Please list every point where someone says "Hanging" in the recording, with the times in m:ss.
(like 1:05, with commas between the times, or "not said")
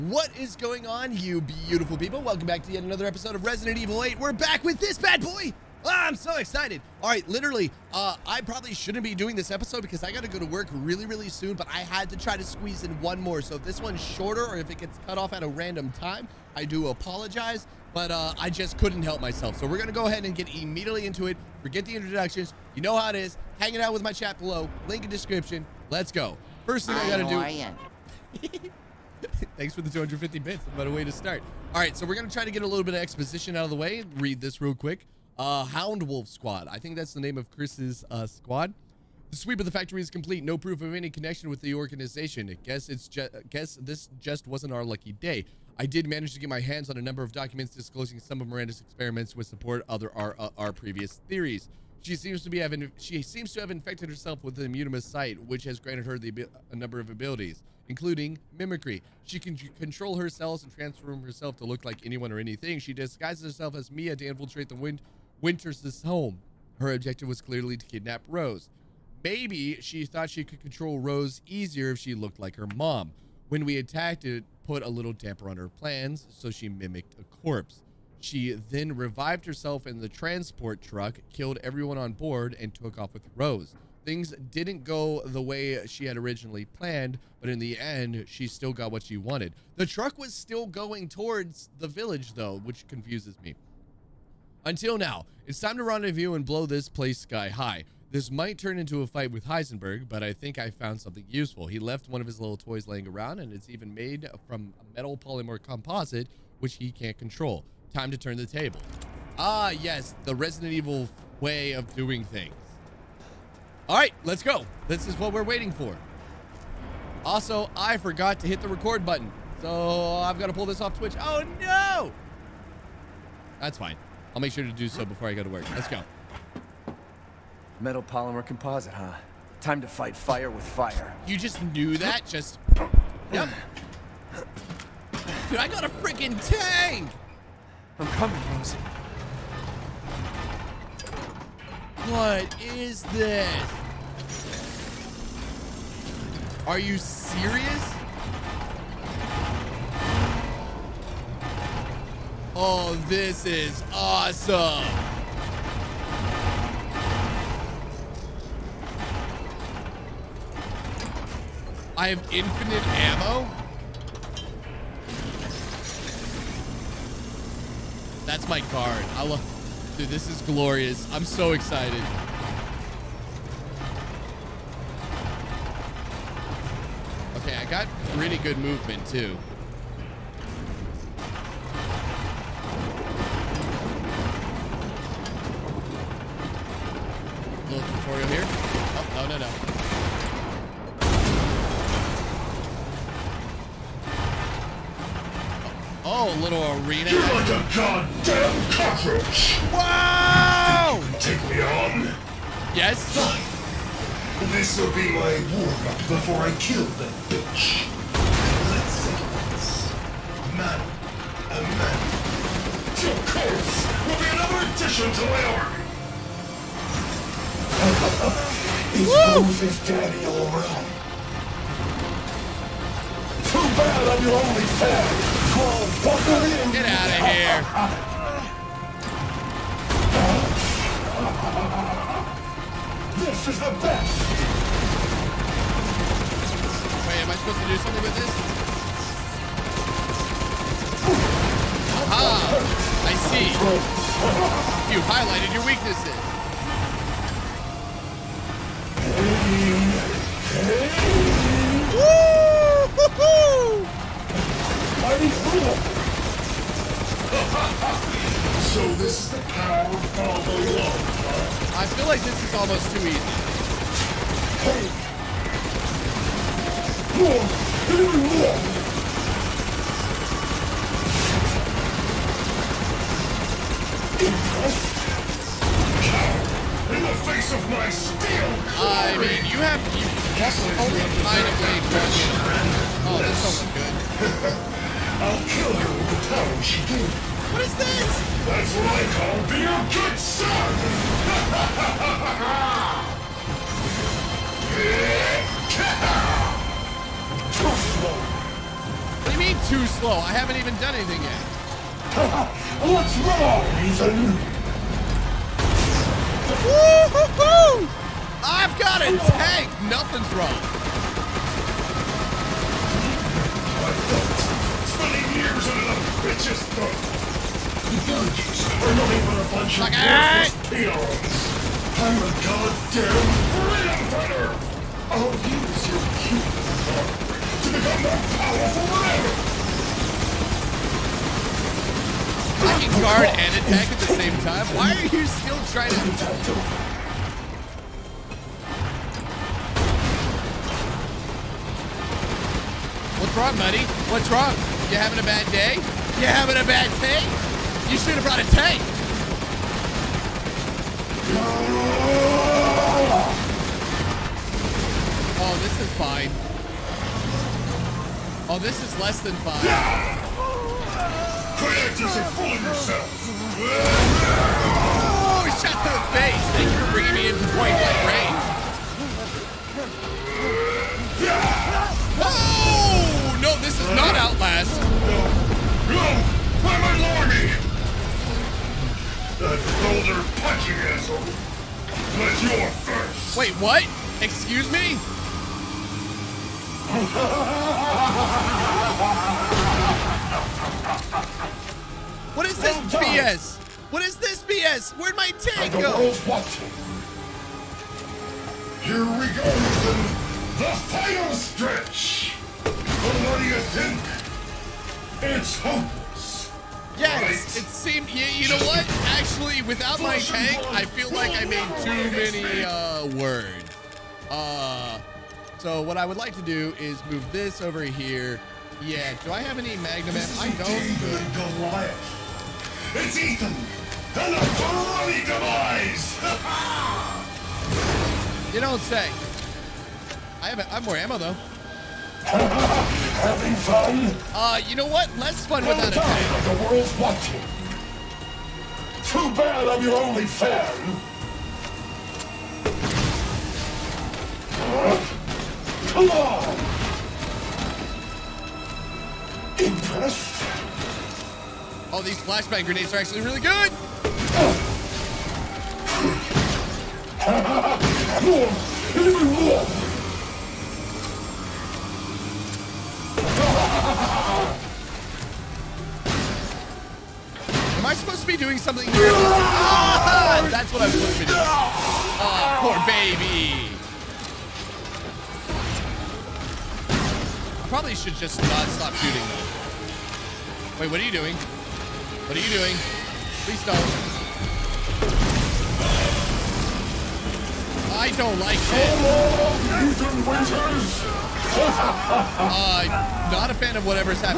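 0:23.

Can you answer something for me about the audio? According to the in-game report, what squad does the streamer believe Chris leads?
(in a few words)
Hound Wolf Squad.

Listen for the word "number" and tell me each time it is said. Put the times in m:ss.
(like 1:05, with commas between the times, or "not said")
0:47, 0:56.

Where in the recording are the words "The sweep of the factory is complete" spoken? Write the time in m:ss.
0:39.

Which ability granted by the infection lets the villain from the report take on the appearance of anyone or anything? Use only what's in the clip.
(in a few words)
mimicry.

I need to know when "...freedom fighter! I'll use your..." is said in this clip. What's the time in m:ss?
5:23.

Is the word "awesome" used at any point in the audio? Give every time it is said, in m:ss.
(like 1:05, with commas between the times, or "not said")
2:33.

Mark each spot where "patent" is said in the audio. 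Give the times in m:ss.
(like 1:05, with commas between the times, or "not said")
not said.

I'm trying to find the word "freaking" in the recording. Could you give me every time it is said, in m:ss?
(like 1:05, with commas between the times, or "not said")
2:16.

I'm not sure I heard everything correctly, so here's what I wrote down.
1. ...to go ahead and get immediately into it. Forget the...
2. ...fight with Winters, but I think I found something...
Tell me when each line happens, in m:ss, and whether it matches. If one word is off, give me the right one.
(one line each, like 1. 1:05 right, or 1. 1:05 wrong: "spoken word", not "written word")
1. 0:19 right
2. 1:39 wrong: "Heisenberg", not "Winters".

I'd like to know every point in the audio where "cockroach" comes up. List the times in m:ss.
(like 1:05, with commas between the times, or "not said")
3:18.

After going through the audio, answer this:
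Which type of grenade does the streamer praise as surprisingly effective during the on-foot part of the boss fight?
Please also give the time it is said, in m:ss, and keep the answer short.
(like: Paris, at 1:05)
flashbang, at 7:32.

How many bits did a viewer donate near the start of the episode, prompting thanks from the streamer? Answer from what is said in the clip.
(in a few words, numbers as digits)
250.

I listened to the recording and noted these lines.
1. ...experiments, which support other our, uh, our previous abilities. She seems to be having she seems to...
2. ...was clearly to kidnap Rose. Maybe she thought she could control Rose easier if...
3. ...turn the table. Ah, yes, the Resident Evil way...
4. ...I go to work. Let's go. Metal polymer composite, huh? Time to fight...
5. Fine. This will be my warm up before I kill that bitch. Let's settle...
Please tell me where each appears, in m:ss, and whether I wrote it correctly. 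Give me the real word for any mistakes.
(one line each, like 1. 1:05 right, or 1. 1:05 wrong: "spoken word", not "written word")
1. 0:48 wrong: "theories", not "abilities"
2. 1:07 right
3. 1:48 right
4. 2:05 right
5. 3:23 right.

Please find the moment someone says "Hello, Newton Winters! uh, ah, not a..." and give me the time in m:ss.
8:08.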